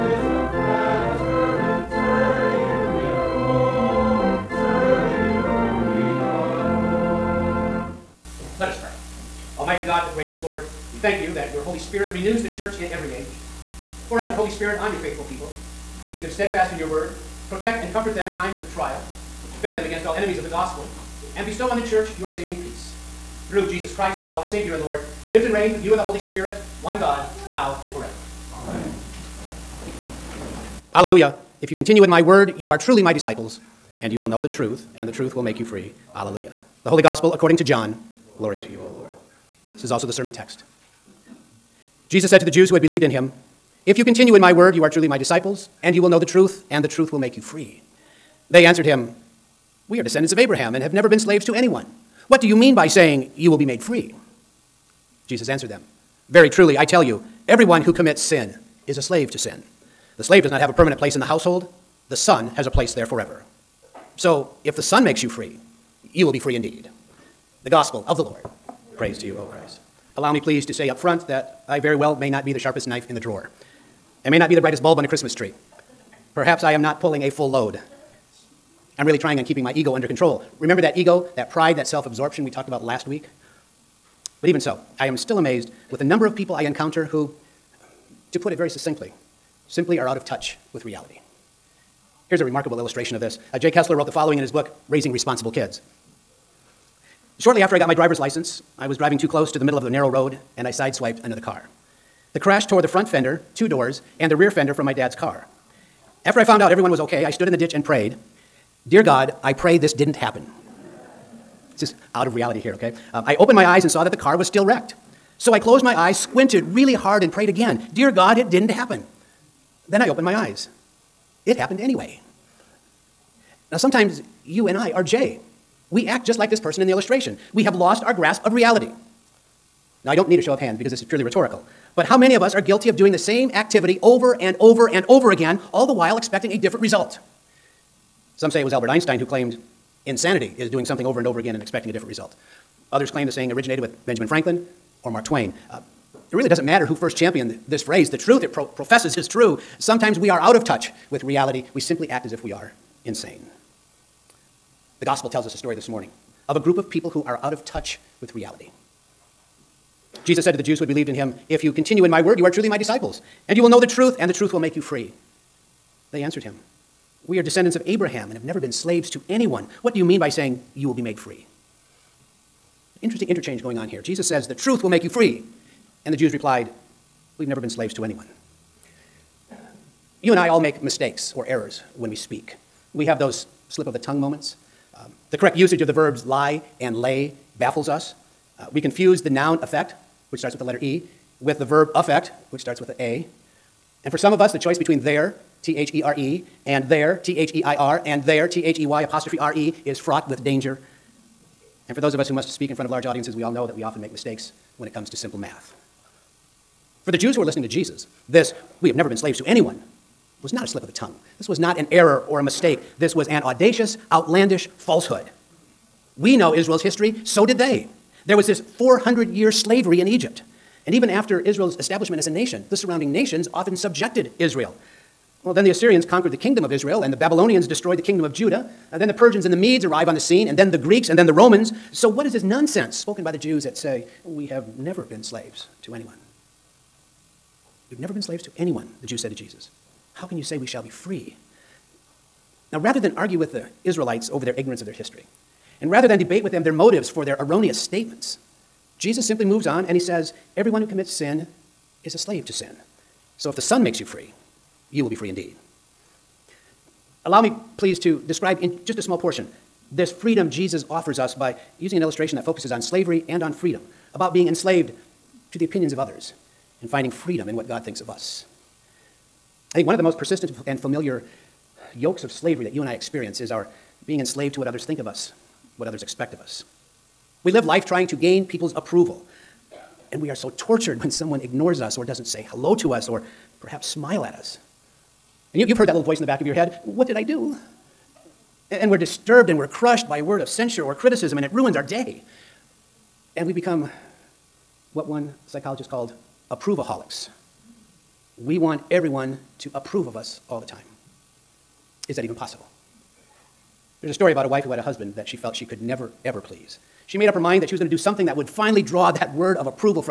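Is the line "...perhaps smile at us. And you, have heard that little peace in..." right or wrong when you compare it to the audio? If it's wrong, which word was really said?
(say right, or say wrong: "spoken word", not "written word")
wrong: "voice", not "peace".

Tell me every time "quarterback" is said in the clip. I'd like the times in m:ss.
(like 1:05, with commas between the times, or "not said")
not said.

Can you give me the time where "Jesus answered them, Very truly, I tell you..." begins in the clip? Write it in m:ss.
0:55.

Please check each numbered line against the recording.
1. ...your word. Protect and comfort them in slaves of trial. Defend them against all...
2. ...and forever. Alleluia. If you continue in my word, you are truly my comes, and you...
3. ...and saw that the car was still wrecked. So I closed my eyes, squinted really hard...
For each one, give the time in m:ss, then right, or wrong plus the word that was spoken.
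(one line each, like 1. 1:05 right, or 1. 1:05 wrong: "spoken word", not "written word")
1. 0:16 wrong: "times", not "slaves"
2. 0:27 wrong: "disciples", not "comes"
3. 1:53 right.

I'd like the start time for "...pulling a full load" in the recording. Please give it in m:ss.
1:17.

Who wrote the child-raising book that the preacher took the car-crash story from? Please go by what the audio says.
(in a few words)
Jay Kessler.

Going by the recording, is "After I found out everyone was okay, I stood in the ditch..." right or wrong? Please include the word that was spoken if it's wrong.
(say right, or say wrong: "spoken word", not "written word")
right.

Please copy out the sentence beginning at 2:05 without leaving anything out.
We act just like this person in the illustration.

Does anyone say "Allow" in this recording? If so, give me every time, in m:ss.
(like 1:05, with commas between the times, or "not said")
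1:10, 4:17.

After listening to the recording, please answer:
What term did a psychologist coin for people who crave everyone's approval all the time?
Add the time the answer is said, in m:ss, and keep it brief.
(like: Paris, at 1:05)
approvaholics, at 4:56.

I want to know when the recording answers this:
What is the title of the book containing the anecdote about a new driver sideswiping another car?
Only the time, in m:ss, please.
1:34.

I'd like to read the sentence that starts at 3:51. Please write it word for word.
So, what is this nonsense spoken by the Jews that say, We have never been slaves to anyone?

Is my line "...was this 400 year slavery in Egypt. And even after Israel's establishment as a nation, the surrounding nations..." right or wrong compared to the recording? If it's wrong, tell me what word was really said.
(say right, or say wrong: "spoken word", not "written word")
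right.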